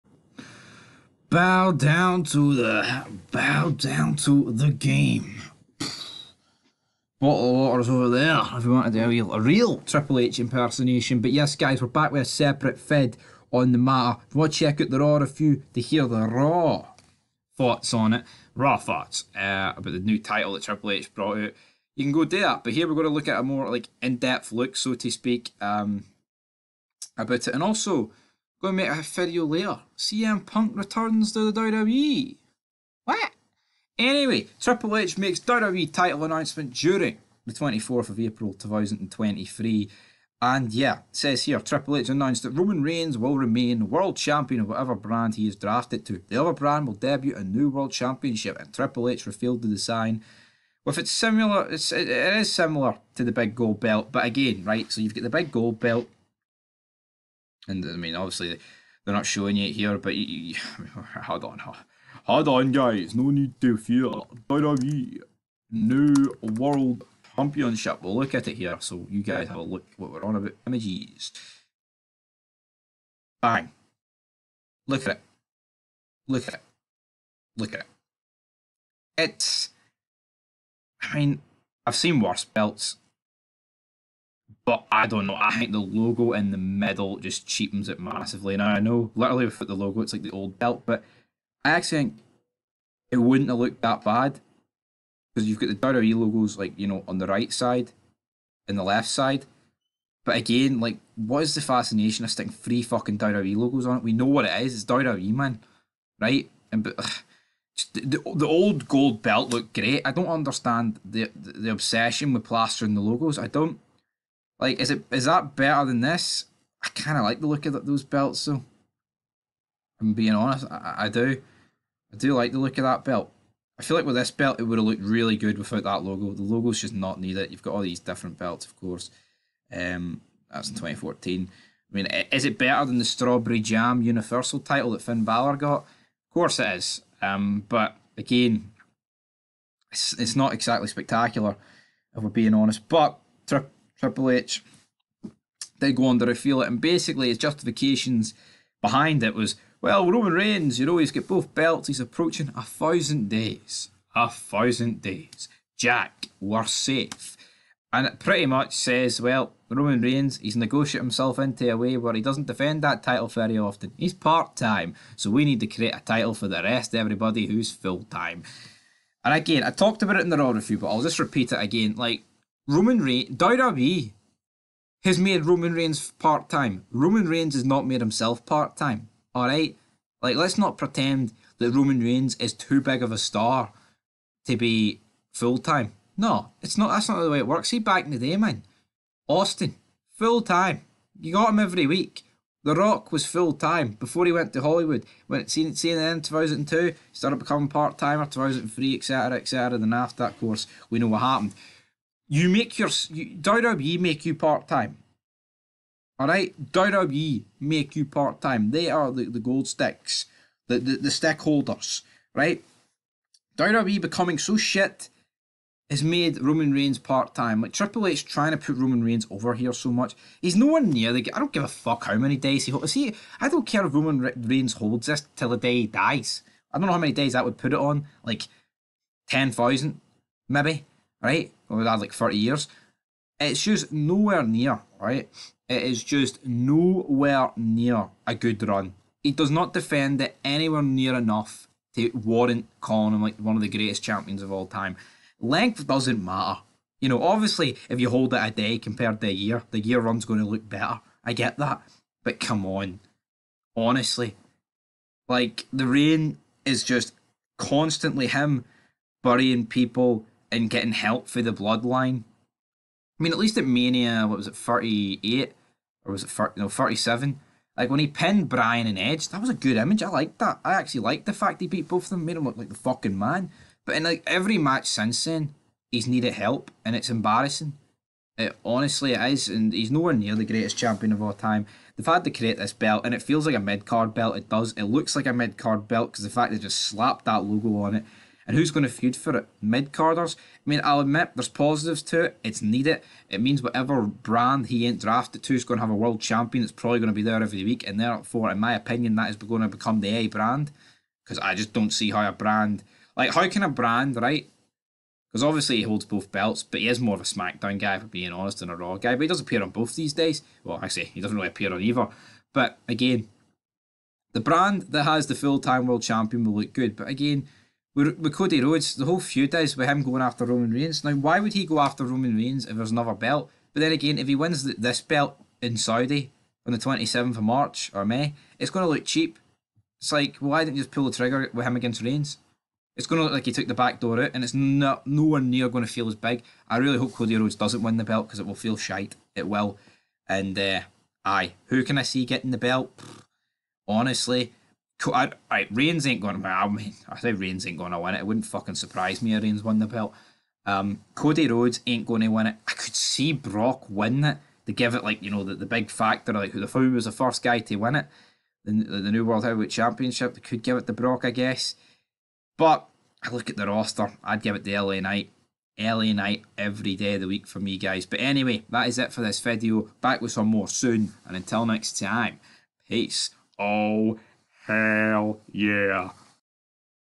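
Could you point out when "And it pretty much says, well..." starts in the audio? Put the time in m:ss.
2:37.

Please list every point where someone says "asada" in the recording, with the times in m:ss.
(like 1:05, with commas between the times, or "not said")
not said.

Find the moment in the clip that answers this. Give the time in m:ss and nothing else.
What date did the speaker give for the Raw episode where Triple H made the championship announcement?
0:37.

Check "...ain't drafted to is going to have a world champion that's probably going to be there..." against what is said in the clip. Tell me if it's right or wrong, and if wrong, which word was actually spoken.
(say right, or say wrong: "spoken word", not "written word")
right.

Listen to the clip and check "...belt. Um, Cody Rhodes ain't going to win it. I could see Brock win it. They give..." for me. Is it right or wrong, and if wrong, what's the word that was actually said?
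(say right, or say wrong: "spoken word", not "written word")
right.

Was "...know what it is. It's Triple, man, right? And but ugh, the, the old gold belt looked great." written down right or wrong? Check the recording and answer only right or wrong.
wrong.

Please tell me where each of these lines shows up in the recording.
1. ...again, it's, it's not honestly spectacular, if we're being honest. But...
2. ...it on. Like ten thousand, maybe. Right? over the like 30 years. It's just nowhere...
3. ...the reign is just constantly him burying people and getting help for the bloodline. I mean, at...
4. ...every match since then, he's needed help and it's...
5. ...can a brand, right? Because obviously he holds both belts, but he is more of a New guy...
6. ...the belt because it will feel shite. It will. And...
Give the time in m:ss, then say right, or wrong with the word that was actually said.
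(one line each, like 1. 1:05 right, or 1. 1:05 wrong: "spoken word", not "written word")
1. 2:18 wrong: "exactly", not "honestly"
2. 3:47 right
3. 4:15 right
4. 4:34 right
5. 5:03 wrong: "SmackDown", not "New"
6. 5:37 right.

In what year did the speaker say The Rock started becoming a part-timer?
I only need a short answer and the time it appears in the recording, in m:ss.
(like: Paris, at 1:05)
2003, at 3:18.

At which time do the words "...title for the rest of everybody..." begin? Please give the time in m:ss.
2:45.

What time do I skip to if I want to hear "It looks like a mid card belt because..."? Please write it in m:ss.
4:44.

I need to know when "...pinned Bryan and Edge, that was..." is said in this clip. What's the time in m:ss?
4:28.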